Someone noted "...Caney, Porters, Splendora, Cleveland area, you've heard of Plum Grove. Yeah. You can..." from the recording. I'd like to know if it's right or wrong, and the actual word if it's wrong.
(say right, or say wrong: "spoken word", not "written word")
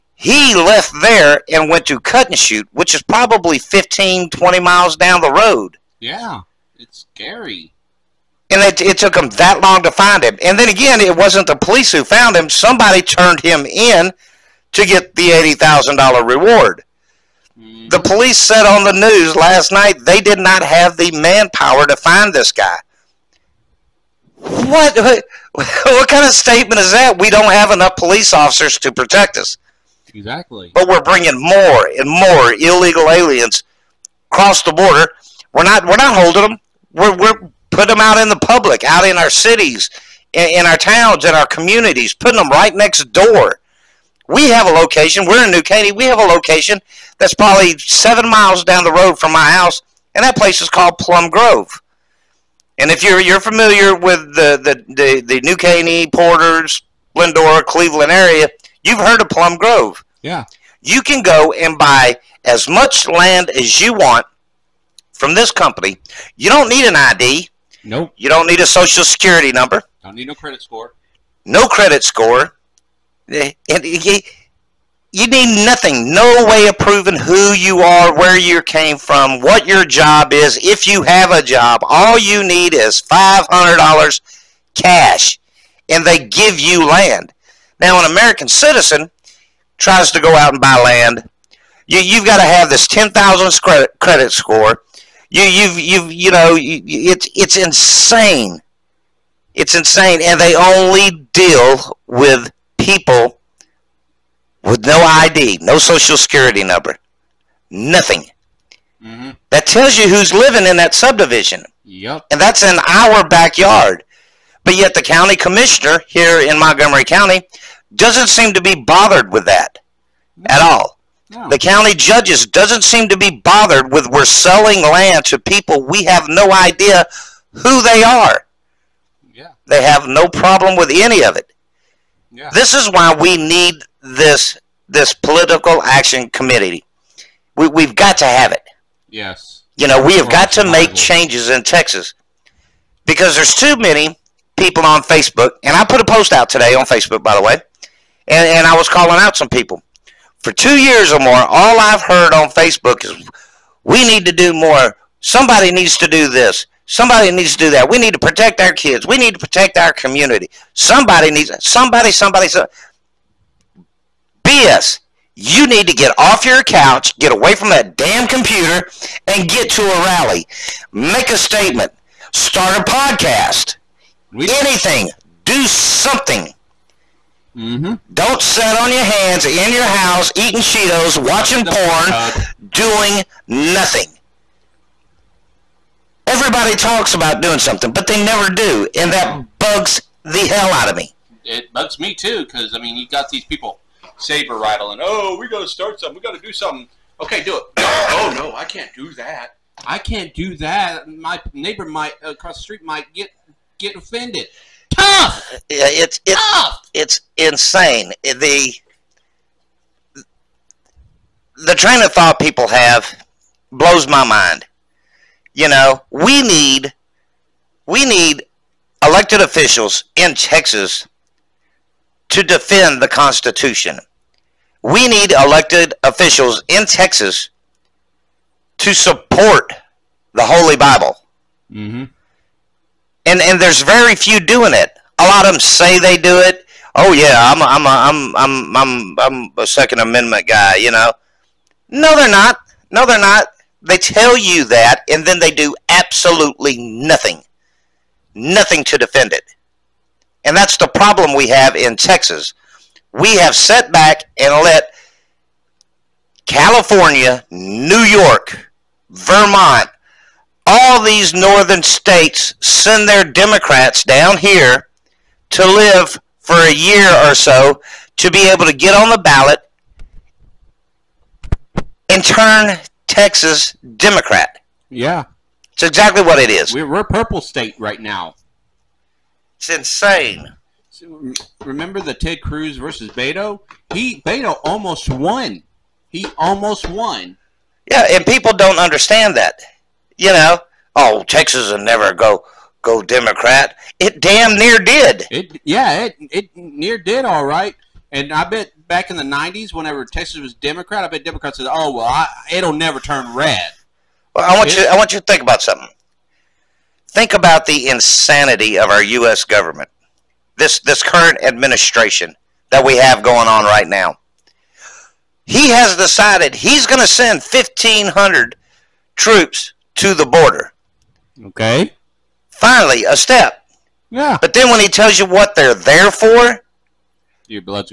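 right.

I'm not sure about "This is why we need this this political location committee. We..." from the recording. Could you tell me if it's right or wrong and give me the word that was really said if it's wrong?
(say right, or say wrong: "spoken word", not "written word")
wrong: "action", not "location".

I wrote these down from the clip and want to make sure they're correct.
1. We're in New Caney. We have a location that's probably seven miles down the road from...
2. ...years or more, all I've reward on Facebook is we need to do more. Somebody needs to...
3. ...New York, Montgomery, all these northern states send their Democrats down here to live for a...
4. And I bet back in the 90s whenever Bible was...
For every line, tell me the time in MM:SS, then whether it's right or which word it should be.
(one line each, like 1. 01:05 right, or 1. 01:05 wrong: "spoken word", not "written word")
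1. 00:45 right
2. 02:30 wrong: "heard", not "reward"
3. 04:17 wrong: "Vermont", not "Montgomery"
4. 04:58 wrong: "Texas", not "Bible".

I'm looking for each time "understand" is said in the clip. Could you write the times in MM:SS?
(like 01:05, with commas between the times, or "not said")
04:48.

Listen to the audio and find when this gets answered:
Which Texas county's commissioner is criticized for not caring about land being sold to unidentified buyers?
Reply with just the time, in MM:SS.
01:56.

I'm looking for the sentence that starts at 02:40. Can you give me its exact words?
Somebody needs somebody somebody so BS.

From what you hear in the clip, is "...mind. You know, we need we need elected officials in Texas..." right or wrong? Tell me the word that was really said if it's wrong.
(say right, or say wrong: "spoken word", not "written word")
right.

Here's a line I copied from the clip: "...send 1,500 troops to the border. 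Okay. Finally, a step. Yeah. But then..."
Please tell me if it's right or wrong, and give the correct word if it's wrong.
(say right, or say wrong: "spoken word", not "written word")
right.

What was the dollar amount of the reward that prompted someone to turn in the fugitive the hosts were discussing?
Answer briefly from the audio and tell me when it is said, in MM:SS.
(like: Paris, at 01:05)
$80,000, at 00:15.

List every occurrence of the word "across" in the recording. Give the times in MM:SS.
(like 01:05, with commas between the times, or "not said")
00:34, 03:22.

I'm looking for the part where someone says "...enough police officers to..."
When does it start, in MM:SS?
00:27.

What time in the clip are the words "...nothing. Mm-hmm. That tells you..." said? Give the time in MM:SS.
01:47.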